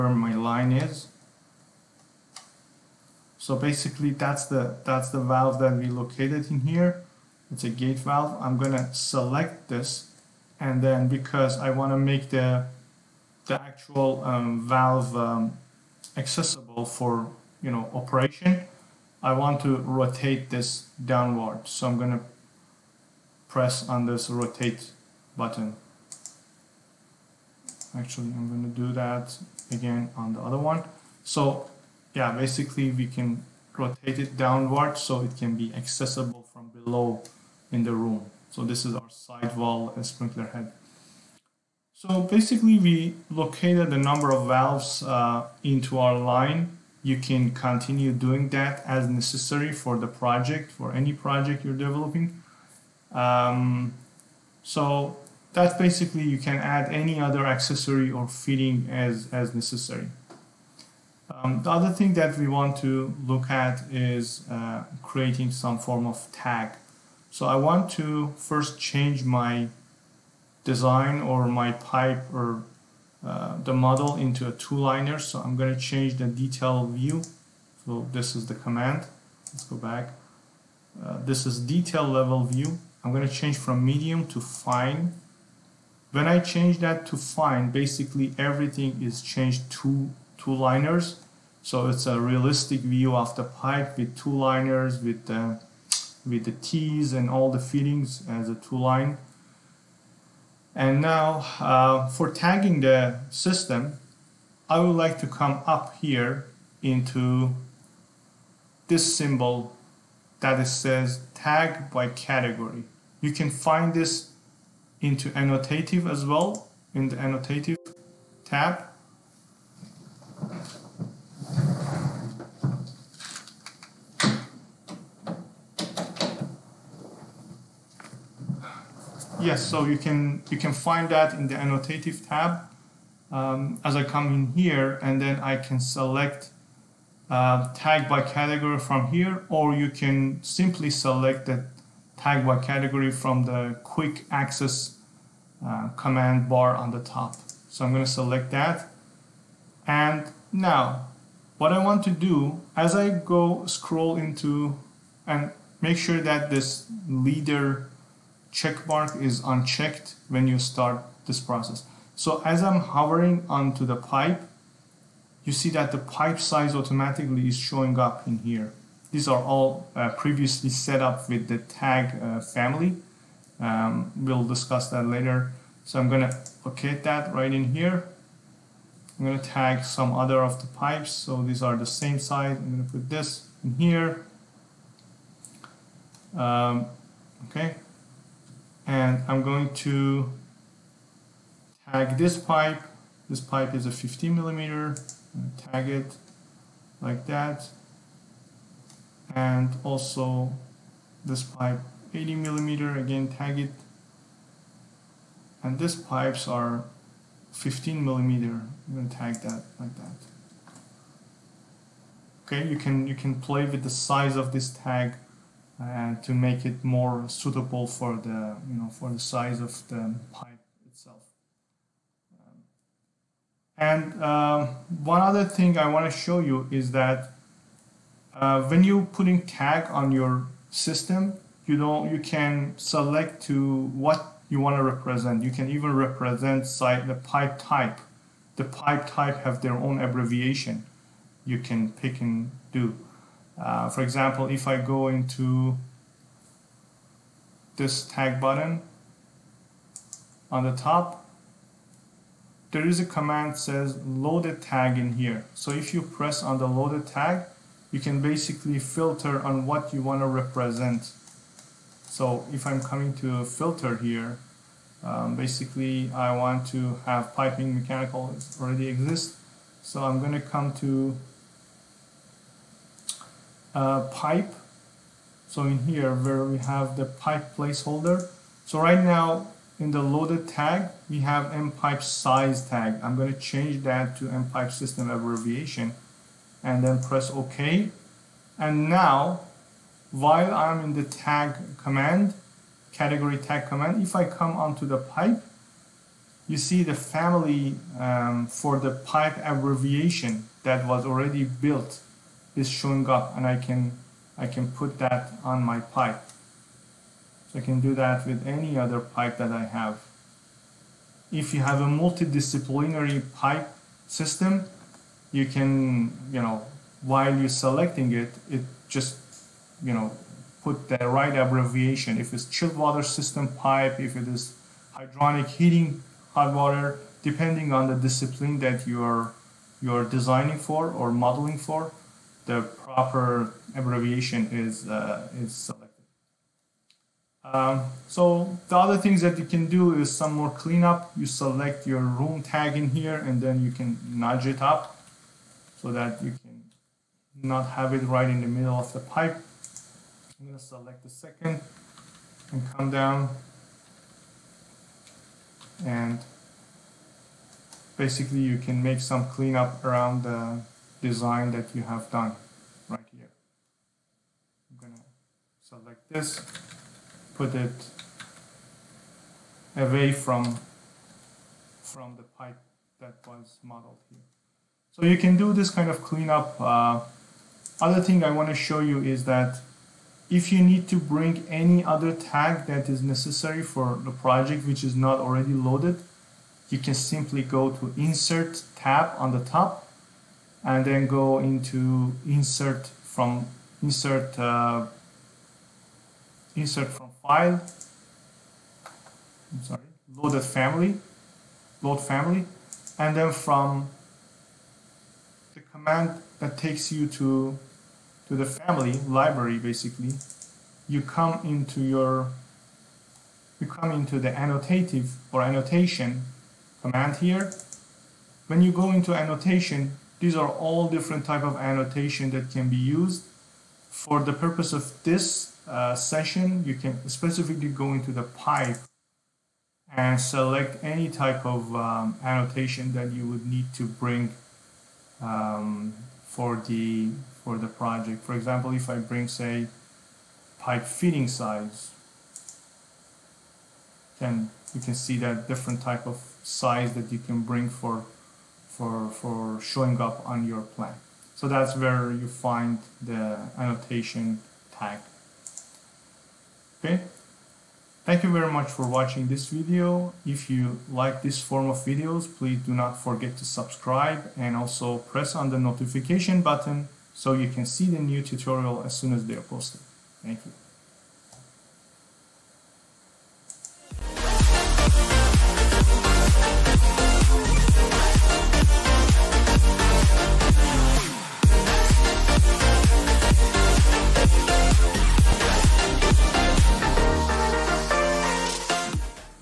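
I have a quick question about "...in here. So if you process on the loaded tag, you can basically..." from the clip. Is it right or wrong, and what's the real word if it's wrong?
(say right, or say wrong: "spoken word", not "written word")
wrong: "press", not "process".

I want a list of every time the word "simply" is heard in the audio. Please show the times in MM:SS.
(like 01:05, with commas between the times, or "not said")
02:20, 06:26.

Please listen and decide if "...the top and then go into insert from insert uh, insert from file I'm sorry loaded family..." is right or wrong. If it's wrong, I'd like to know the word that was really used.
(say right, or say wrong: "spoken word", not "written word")
right.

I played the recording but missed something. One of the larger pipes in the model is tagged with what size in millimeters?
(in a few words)
80 millimeter.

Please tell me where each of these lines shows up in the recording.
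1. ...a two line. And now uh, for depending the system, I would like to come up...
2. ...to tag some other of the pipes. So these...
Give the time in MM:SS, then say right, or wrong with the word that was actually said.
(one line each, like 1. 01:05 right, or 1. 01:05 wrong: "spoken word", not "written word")
1. 01:38 wrong: "tagging", not "depending"
2. 02:59 right.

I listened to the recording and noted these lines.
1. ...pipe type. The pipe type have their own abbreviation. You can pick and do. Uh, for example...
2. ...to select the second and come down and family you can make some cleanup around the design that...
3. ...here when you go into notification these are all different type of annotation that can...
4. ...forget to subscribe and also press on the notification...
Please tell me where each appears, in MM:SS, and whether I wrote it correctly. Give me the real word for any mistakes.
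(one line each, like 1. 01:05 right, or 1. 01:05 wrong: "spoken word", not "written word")
1. 03:57 right
2. 05:50 wrong: "basically", not "family"
3. 06:57 wrong: "annotation", not "notification"
4. 07:43 right.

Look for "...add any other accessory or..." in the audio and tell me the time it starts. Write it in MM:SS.
00:56.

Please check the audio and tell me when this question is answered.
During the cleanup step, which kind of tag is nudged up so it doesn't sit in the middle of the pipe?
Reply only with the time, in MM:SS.
05:42.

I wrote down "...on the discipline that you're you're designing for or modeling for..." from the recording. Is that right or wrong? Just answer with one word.
right.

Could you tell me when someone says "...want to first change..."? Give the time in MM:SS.
01:07.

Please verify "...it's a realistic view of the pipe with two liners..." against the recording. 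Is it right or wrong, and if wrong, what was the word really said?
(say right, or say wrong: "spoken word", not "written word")
right.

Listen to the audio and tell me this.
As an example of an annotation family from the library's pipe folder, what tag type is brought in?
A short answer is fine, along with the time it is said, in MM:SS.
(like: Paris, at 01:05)
Pipe fitting size, at 07:20.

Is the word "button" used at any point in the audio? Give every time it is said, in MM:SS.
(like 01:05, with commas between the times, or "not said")
00:25, 04:08, 07:46.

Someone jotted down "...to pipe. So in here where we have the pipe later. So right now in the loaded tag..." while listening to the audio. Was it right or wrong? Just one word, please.
wrong.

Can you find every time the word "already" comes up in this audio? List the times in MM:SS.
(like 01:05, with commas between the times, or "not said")
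04:28, 05:01, 06:25.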